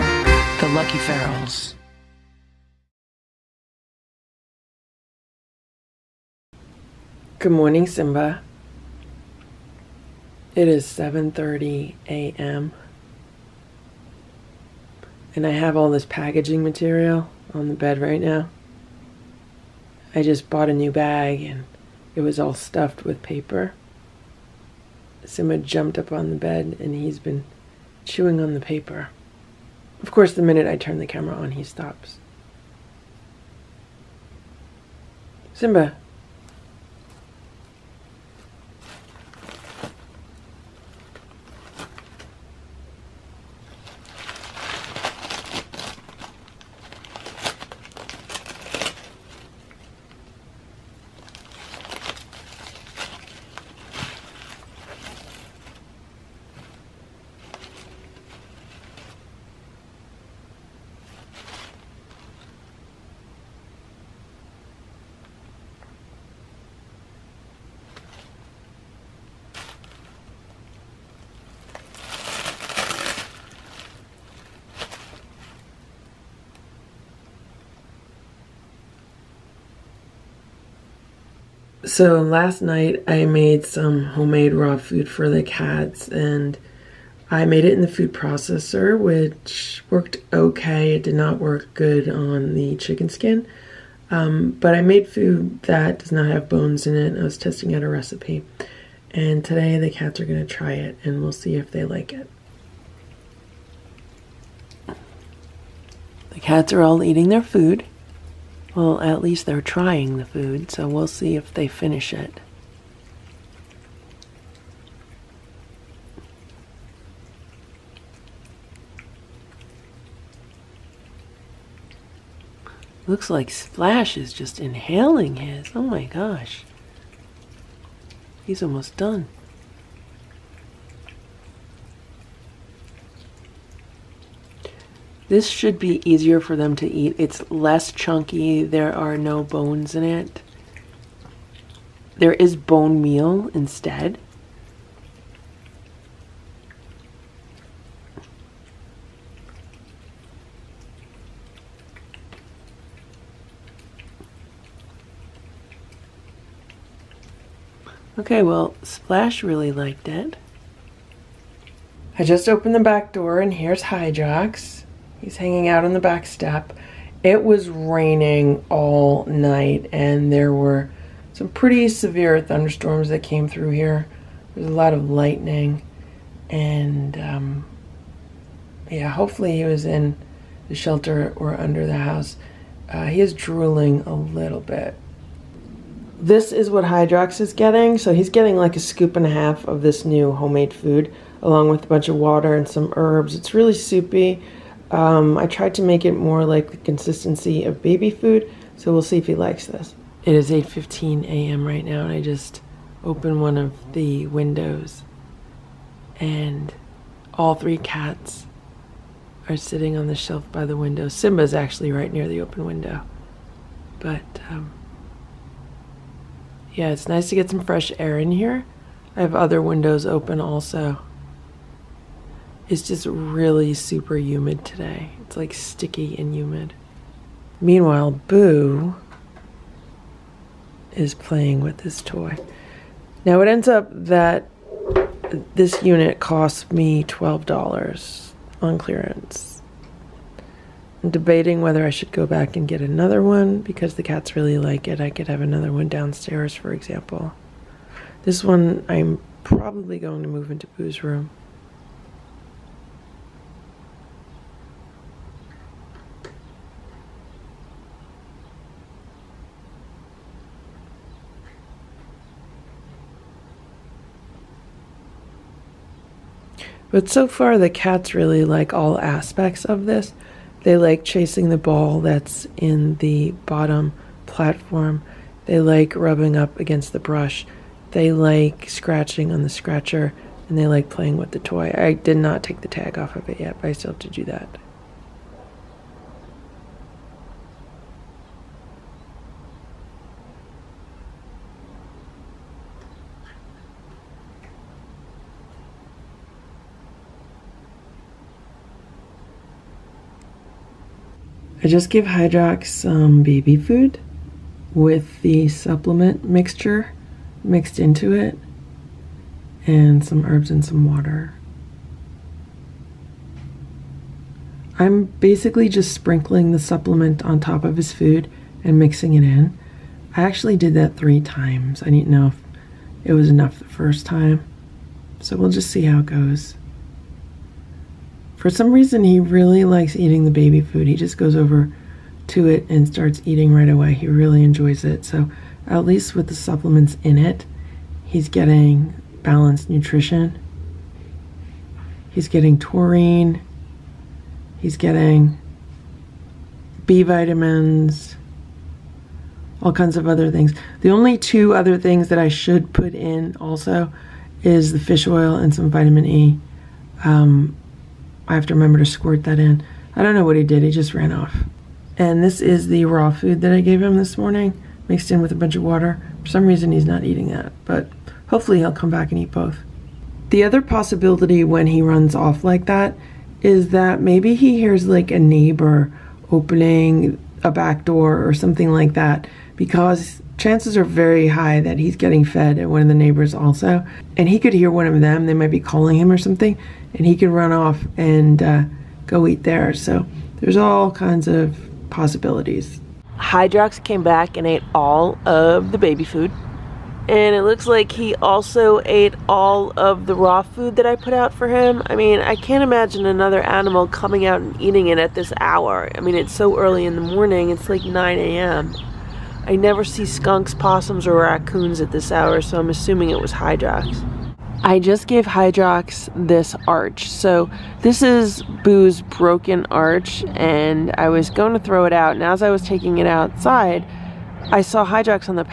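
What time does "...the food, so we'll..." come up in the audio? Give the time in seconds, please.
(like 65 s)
110 s.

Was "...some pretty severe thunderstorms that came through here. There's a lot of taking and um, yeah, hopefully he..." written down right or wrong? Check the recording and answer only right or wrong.
wrong.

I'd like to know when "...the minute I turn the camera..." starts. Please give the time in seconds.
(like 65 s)
30 s.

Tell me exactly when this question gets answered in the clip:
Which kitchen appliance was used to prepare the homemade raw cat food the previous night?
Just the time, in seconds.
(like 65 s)
87 s.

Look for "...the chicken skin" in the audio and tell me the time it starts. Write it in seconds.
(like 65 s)
92 s.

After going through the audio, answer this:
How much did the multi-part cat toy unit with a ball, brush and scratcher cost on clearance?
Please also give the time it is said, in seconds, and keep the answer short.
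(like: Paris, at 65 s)
$12, at 237 s.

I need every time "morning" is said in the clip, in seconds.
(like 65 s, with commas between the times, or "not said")
7 s, 364 s, 407 s.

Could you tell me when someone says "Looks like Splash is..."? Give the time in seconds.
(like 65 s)
123 s.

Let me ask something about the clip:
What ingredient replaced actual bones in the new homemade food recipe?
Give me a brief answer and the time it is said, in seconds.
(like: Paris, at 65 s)
bone meal, at 142 s.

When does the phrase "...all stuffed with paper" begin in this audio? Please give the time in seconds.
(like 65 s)
22 s.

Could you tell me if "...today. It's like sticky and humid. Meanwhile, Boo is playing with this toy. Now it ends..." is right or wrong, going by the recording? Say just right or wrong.
right.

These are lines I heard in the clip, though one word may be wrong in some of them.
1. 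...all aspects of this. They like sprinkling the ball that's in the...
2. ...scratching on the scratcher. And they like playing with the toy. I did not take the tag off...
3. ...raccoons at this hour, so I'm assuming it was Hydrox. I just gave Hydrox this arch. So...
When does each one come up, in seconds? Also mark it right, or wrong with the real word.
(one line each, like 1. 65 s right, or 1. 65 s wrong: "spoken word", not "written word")
1. 268 s wrong: "chasing", not "sprinkling"
2. 278 s right
3. 411 s right.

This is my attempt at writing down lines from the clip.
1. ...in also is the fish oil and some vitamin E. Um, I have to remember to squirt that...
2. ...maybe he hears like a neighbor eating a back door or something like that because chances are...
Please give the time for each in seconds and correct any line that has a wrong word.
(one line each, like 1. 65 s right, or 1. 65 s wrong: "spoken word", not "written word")
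1. 352 s right
2. 374 s wrong: "opening", not "eating".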